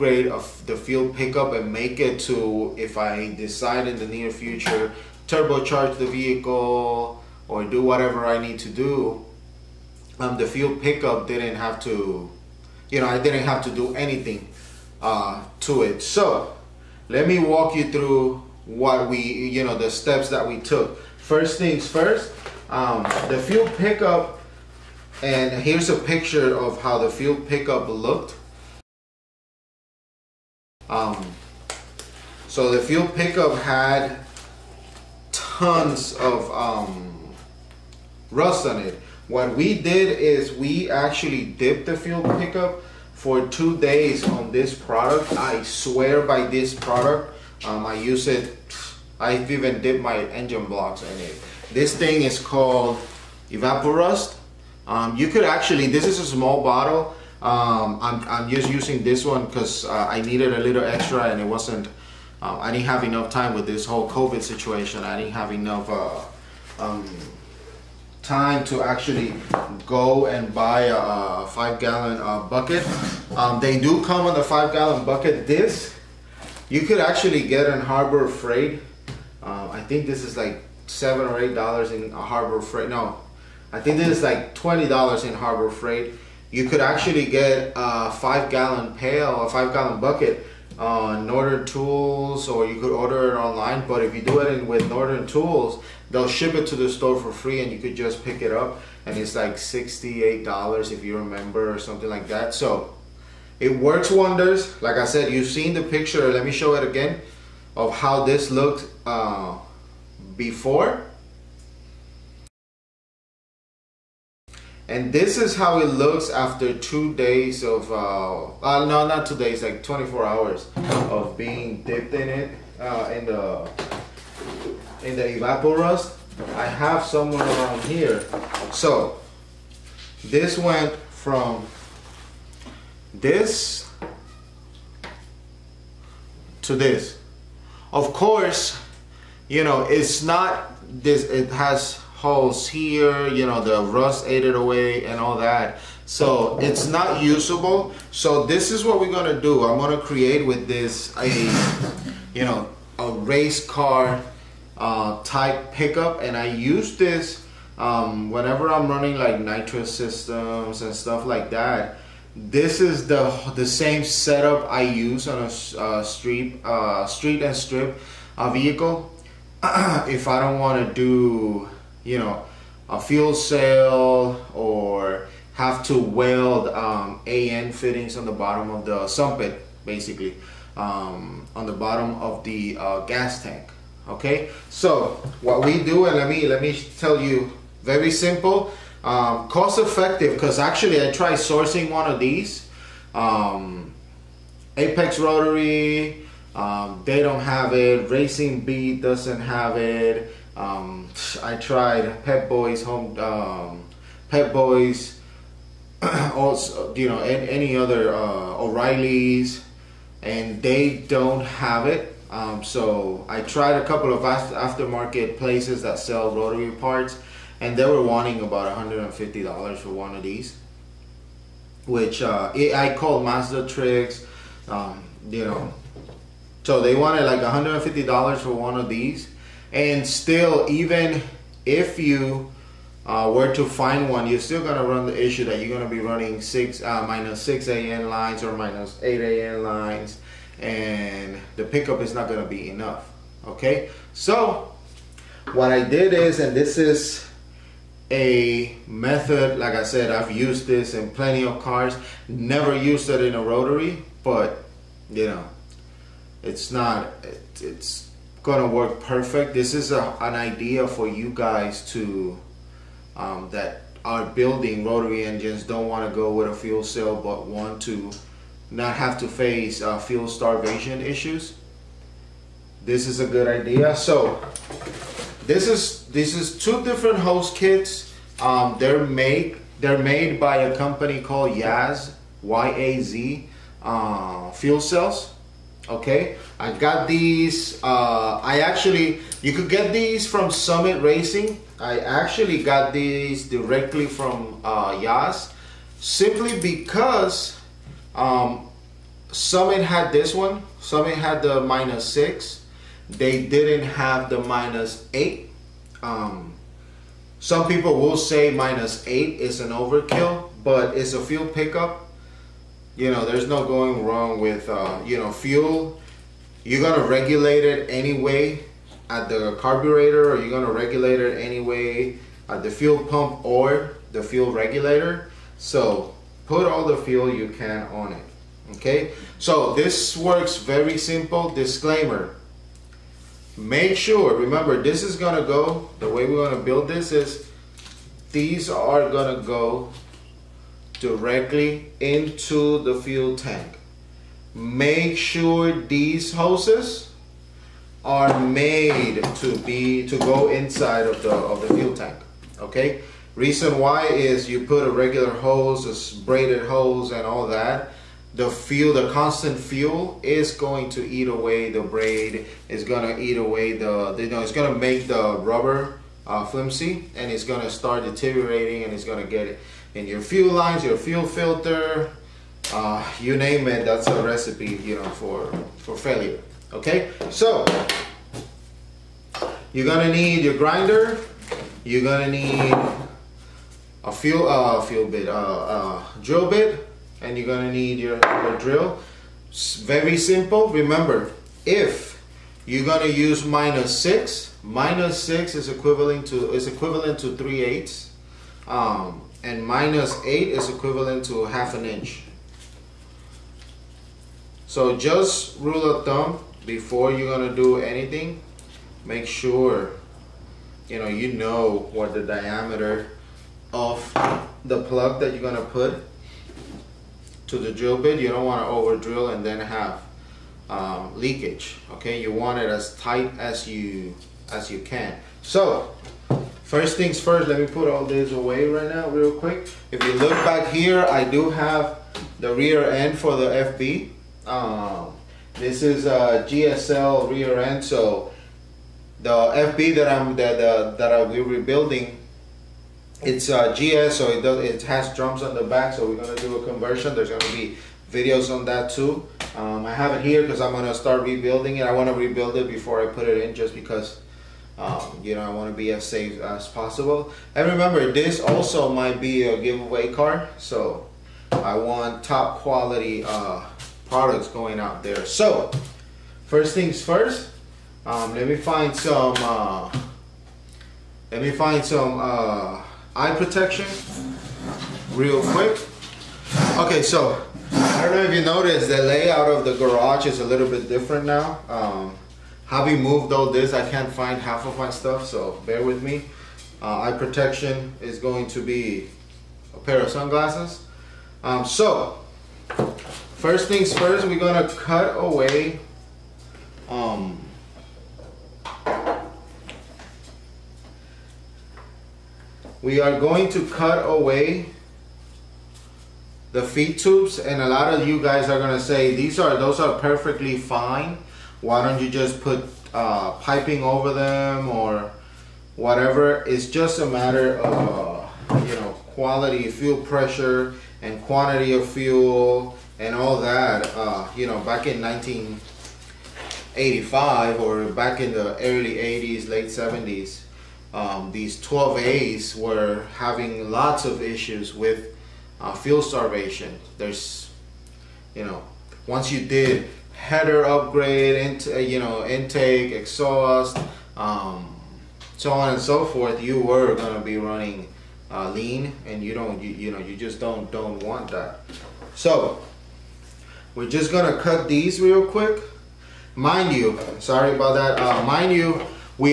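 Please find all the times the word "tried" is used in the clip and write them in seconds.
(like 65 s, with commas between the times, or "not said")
191 s, 201 s, 213 s.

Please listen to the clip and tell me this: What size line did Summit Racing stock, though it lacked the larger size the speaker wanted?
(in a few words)
minus 6.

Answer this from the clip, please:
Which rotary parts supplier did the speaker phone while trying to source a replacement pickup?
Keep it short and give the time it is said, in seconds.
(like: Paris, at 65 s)
Mazda Tricks, at 223 s.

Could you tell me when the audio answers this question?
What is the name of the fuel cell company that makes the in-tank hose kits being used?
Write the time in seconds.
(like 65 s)
281 s.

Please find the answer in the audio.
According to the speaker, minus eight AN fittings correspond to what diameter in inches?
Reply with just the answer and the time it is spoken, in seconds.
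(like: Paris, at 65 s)
half an inch, at 401 s.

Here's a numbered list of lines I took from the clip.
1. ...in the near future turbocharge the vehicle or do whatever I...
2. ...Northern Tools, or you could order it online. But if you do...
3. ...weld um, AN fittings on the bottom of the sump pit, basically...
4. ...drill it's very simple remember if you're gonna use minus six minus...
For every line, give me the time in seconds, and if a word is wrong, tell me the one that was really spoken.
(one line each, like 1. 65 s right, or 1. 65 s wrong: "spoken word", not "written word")
1. 3 s right
2. 91 s right
3. 175 s right
4. 388 s right.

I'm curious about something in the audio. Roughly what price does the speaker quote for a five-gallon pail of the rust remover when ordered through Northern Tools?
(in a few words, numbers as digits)
$68.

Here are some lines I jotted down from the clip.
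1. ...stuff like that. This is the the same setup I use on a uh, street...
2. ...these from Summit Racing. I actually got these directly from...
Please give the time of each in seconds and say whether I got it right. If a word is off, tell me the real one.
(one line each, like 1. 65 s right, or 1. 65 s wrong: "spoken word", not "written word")
1. 160 s right
2. 289 s right.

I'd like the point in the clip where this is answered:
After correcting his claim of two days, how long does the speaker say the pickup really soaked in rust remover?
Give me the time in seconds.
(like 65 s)
119 s.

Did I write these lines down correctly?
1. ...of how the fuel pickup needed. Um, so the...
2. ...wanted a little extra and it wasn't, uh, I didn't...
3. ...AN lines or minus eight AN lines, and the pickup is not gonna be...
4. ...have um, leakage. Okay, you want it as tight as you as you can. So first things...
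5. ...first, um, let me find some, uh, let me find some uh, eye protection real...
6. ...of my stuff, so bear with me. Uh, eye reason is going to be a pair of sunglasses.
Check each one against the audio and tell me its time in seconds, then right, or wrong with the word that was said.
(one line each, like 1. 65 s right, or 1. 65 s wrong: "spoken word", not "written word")
1. 26 s wrong: "looked", not "needed"
2. 60 s wrong: "needed", not "wanted"
3. 237 s right
4. 419 s right
5. 467 s right
6. 484 s wrong: "protection", not "reason".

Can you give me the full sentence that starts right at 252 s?
Never used it in a rotary, but you know, it's not.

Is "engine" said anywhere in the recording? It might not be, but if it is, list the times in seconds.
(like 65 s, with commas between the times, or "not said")
50 s, 265 s.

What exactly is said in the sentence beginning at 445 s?
So we're gonna do a conversion.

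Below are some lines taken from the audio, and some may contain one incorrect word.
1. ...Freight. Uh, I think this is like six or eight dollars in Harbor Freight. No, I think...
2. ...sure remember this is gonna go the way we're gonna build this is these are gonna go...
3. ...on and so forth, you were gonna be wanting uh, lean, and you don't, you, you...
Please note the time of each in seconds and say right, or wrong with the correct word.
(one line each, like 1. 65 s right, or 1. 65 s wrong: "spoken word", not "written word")
1. 78 s wrong: "seven", not "six"
2. 333 s right
3. 545 s wrong: "running", not "wanting".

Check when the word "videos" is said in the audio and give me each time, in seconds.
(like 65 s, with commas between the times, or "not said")
448 s.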